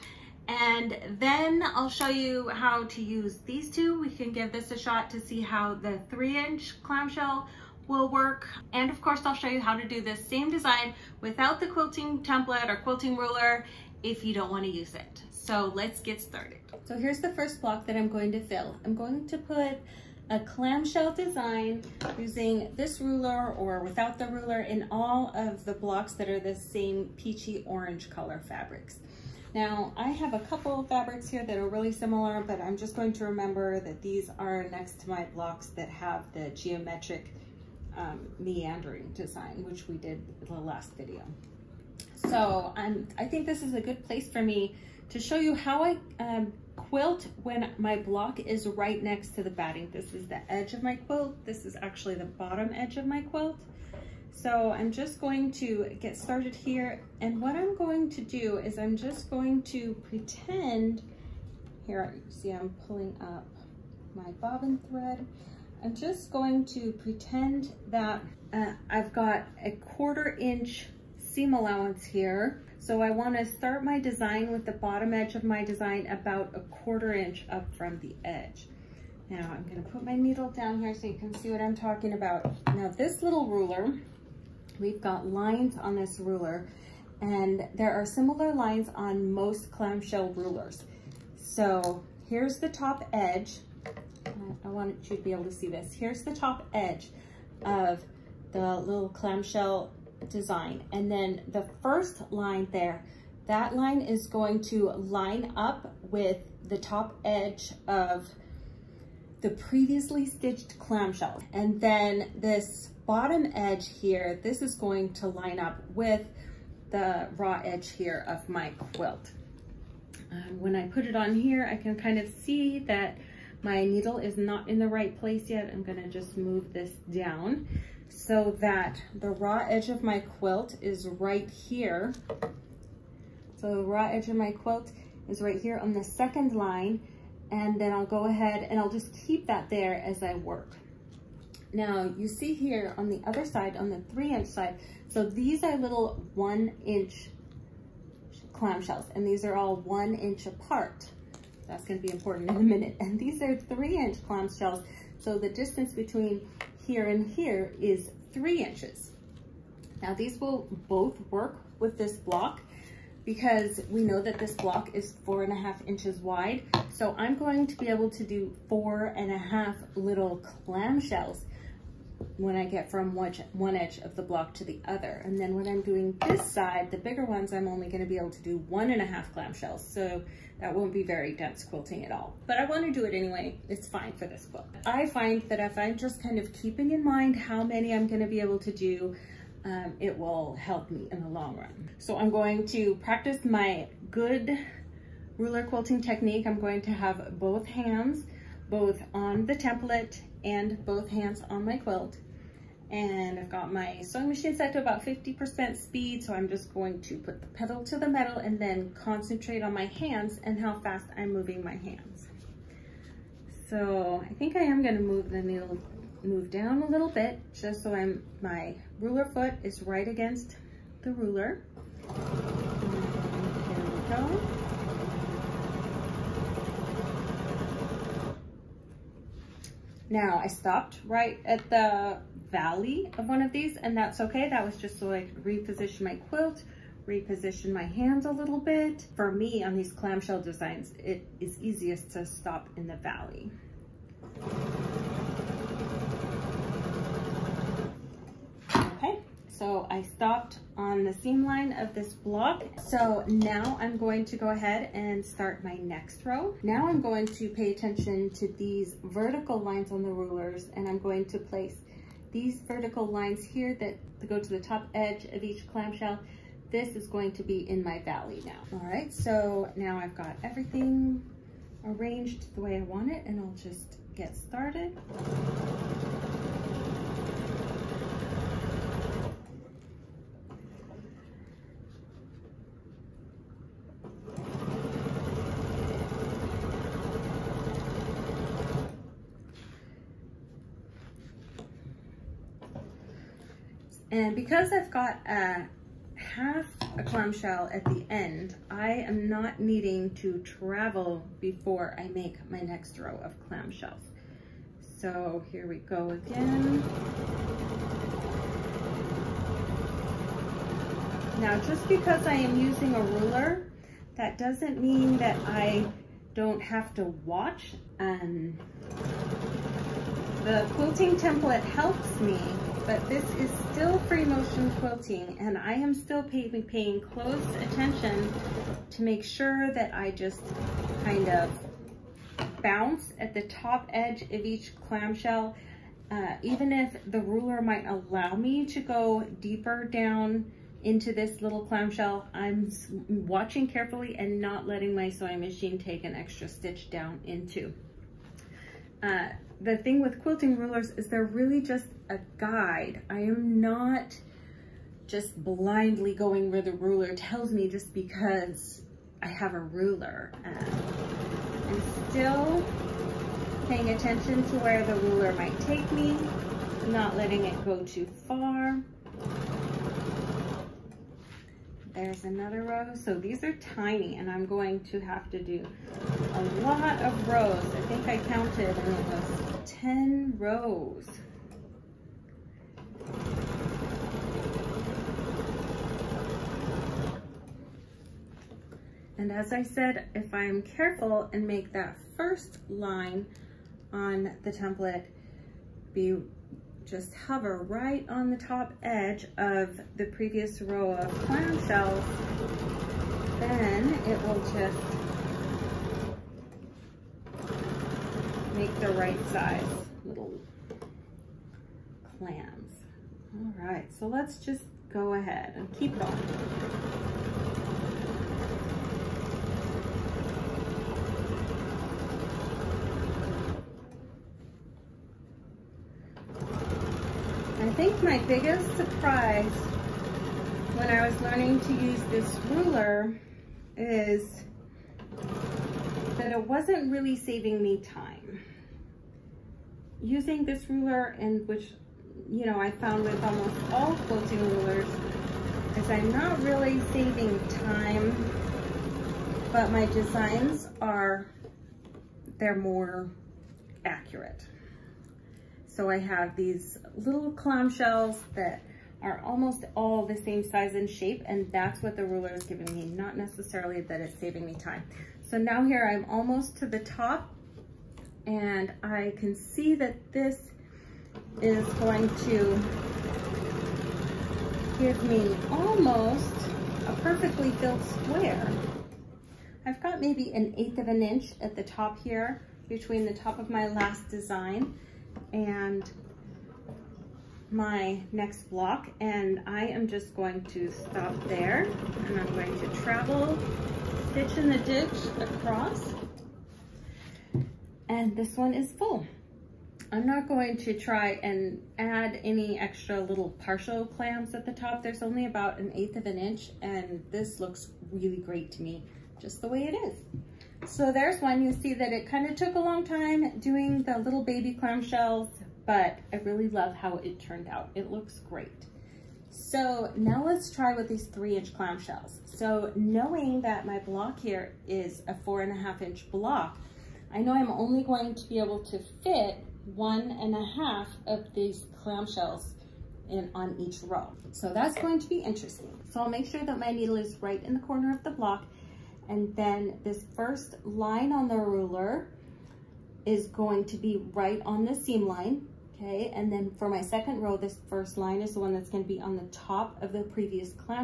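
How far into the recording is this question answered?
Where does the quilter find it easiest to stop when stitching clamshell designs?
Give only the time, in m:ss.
4:02.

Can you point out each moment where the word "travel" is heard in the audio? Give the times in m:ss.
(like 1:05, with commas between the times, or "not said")
5:00, 8:12.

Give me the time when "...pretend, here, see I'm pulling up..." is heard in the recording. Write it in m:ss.
1:00.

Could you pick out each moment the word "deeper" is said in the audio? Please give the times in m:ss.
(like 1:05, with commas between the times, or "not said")
5:39.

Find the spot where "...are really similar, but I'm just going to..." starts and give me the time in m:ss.
0:31.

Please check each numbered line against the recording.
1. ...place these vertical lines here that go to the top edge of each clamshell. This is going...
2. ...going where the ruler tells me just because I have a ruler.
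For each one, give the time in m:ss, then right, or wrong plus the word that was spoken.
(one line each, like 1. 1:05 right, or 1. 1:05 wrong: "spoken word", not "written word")
1. 4:21 right
2. 5:56 right.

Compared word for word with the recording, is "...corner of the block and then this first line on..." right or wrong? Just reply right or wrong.
right.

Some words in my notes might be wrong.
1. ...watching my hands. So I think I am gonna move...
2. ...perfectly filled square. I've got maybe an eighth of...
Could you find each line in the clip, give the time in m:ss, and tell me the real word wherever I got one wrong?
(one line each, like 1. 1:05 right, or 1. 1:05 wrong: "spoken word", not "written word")
1. 3:31 wrong: "moving", not "watching"
2. 7:57 right.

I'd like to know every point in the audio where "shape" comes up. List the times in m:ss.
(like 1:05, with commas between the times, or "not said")
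7:40.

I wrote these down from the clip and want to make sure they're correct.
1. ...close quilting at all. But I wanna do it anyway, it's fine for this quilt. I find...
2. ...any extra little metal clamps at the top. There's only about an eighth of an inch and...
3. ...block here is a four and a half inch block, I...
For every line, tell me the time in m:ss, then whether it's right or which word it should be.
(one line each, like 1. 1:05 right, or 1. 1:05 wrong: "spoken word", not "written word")
1. 3:01 wrong: "dense", not "close"
2. 8:22 wrong: "partial", not "metal"
3. 8:43 right.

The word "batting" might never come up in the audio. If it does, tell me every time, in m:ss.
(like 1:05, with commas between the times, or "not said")
0:49.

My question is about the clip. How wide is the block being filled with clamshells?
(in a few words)
4 and a half inches.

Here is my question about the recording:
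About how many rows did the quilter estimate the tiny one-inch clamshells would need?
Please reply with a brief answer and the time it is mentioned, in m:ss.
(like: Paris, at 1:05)
10, at 6:19.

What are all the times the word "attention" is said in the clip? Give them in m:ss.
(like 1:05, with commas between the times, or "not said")
4:17, 5:27, 6:03.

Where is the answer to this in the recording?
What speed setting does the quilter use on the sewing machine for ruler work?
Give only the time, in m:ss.
3:25.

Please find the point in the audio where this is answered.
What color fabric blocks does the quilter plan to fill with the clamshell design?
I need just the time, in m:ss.
0:27.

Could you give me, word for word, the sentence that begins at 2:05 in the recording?
I'm gonna just move this down so that the raw edge of my quilt is right here.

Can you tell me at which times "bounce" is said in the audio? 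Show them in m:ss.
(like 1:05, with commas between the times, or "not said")
5:32.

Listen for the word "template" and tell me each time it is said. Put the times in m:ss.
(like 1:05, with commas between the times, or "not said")
0:12, 3:19, 5:21, 6:34.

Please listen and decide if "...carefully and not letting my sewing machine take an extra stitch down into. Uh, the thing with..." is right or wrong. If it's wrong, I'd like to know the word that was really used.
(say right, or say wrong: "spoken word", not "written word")
right.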